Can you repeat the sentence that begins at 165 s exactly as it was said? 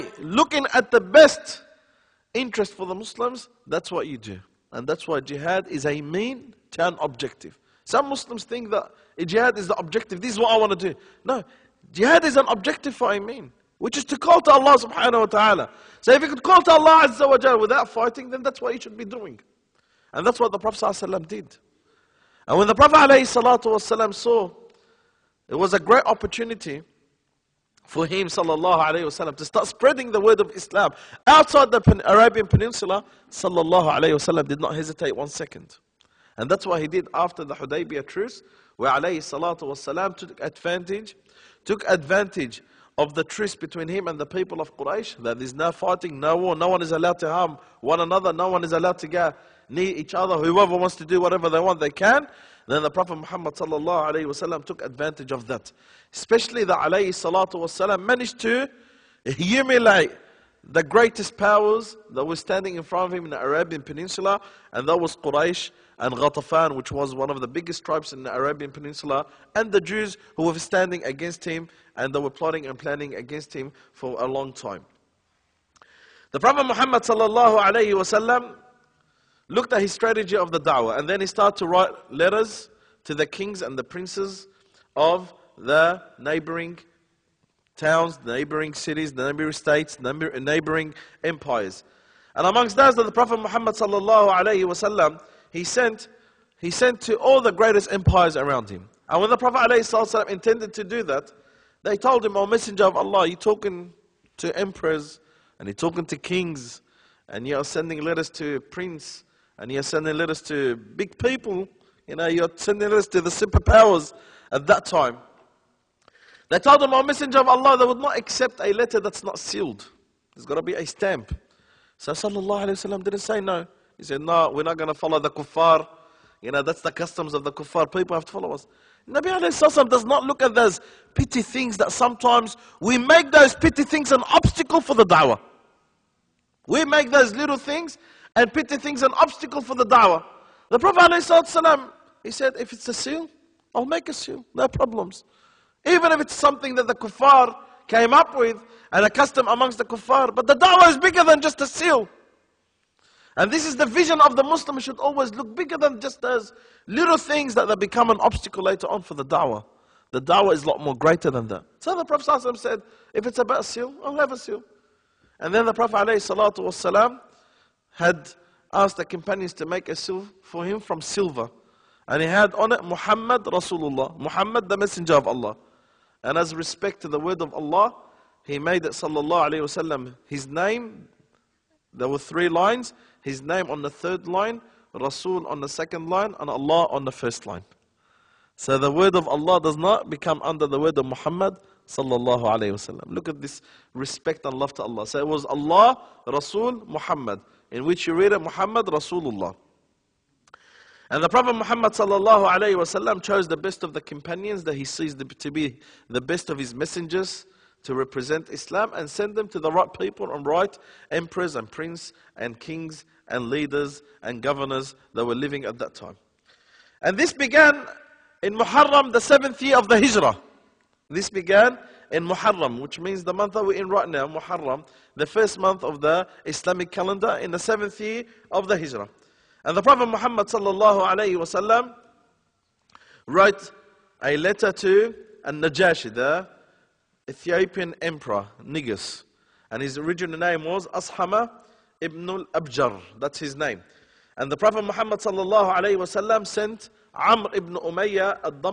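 And then the Prophet ﷺ had asked the companions to make a silver for him from silver.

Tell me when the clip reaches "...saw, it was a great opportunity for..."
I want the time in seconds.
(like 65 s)
24 s.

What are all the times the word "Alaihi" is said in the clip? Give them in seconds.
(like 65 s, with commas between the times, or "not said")
122 s, 129 s.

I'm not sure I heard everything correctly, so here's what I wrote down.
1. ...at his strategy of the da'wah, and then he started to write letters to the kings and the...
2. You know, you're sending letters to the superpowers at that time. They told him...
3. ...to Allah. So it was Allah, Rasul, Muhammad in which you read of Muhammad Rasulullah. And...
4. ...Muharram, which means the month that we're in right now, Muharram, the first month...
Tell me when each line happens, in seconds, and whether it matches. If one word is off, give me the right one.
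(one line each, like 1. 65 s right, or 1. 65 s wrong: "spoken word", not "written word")
1. 79 s right
2. 112 s right
3. 194 s right
4. 222 s right.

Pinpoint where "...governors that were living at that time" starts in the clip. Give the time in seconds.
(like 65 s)
214 s.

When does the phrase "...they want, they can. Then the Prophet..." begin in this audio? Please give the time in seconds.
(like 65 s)
51 s.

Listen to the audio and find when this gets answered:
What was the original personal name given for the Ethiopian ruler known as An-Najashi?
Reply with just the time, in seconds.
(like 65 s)
240 s.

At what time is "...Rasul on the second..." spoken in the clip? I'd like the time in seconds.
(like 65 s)
184 s.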